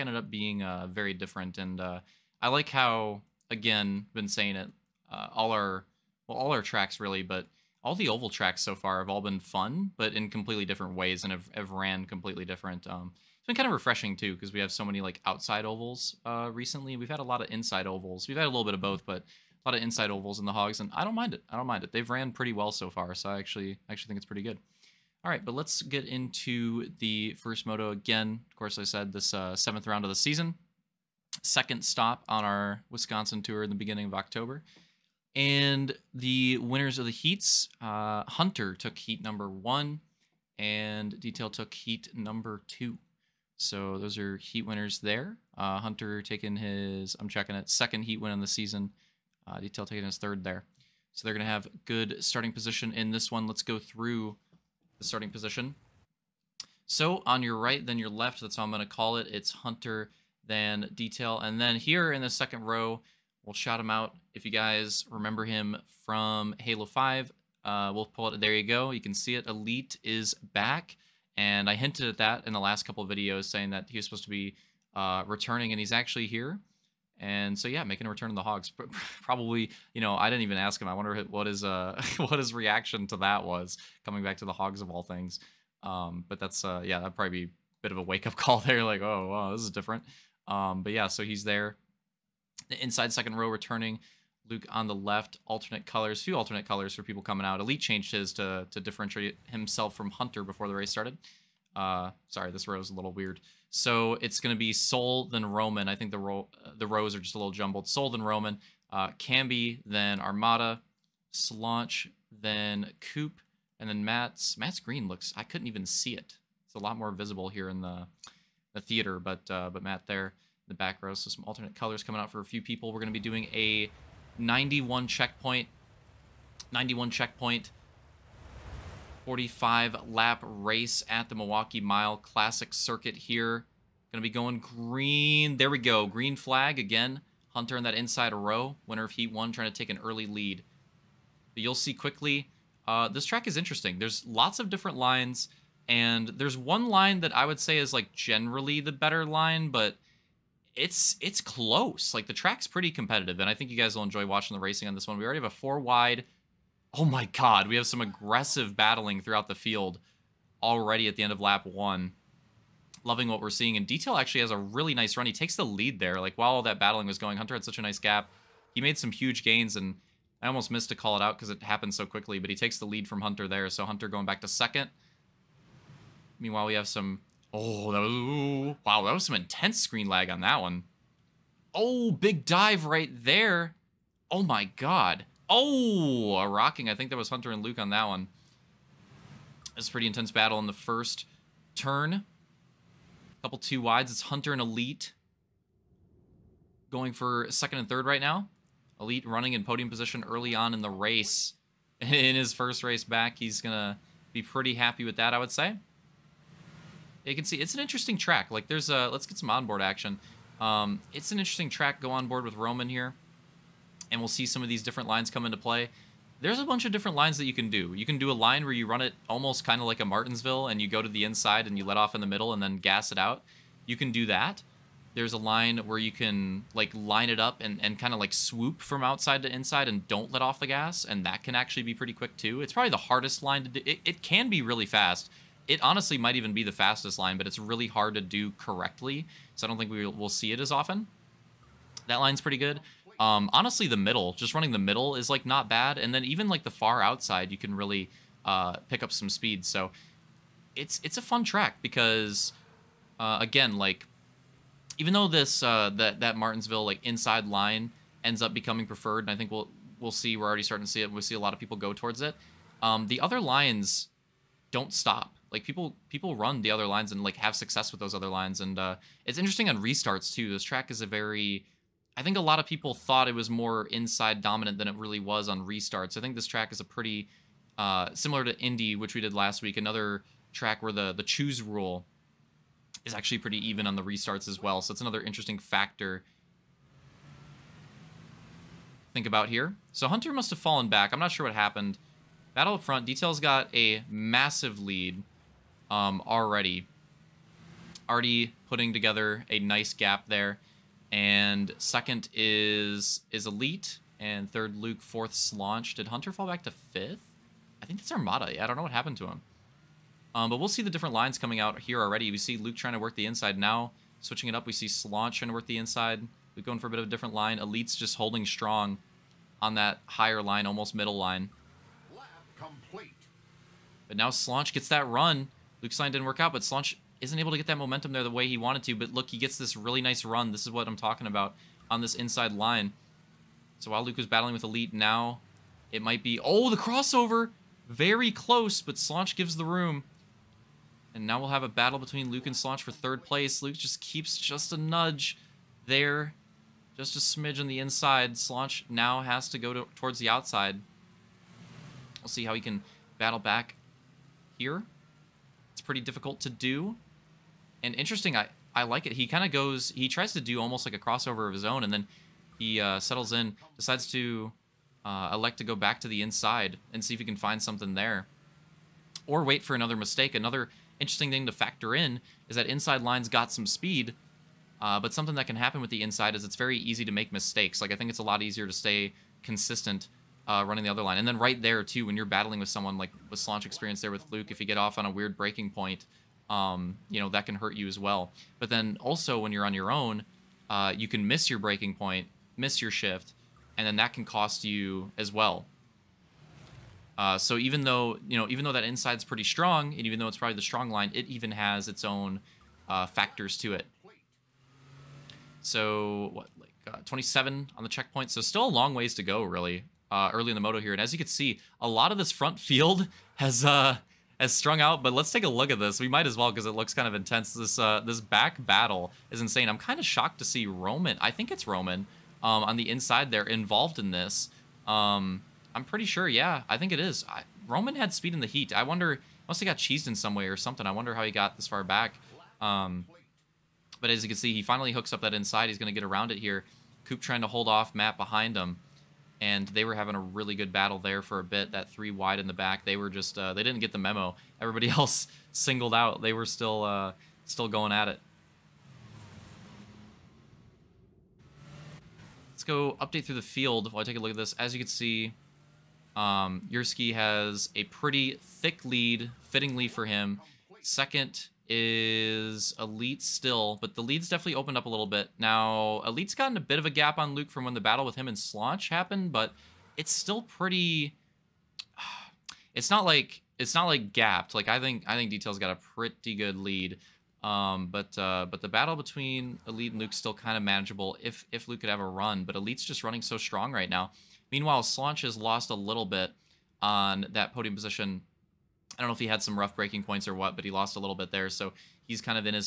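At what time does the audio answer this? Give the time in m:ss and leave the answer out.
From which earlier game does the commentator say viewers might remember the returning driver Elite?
1:06.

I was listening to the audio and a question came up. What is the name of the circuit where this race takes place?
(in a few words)
Milwaukee Mile Classic Circuit.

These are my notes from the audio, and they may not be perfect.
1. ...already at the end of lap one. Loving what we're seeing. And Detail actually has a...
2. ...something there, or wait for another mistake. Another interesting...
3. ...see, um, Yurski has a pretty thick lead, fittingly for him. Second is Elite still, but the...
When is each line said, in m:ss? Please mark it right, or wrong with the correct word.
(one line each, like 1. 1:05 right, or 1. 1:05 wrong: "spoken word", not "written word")
1. 2:40 right
2. 6:07 right
3. 7:34 right.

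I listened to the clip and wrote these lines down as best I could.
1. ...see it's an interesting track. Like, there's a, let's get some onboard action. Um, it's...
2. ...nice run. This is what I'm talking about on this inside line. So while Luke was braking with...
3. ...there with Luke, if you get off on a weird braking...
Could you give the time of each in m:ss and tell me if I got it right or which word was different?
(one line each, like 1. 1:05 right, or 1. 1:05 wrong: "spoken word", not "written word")
1. 3:27 right
2. 5:30 wrong: "battling", not "braking"
3. 6:24 right.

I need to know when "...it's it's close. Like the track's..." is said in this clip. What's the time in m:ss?
2:30.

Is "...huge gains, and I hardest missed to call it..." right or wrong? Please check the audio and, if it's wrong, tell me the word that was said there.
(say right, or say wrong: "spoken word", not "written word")
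wrong: "almost", not "hardest".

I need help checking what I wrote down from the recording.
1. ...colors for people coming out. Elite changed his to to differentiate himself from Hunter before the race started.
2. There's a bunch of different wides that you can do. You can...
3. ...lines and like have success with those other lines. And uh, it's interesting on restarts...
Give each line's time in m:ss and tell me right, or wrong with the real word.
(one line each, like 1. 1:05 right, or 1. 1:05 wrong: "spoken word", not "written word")
1. 1:36 right
2. 3:36 wrong: "lines", not "wides"
3. 4:26 right.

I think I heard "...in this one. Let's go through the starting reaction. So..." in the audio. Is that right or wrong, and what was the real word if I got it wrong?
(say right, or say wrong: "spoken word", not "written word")
wrong: "position", not "reaction".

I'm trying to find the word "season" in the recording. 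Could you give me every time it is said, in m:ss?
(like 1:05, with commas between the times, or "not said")
0:30, 0:48.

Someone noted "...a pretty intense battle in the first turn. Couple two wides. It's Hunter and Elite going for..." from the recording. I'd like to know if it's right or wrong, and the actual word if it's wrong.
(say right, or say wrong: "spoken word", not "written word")
right.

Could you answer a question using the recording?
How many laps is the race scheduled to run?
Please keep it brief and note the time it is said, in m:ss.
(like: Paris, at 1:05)
45, at 2:09.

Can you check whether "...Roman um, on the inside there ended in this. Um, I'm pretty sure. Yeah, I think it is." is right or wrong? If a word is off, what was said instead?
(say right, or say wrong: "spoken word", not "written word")
wrong: "involved", not "ended".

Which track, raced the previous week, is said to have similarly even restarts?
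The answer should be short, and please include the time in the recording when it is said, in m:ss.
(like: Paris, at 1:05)
Indy, at 4:38.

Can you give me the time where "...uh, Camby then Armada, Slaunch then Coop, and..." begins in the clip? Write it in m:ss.
1:48.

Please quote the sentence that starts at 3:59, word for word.
So I don't think we will see it as often.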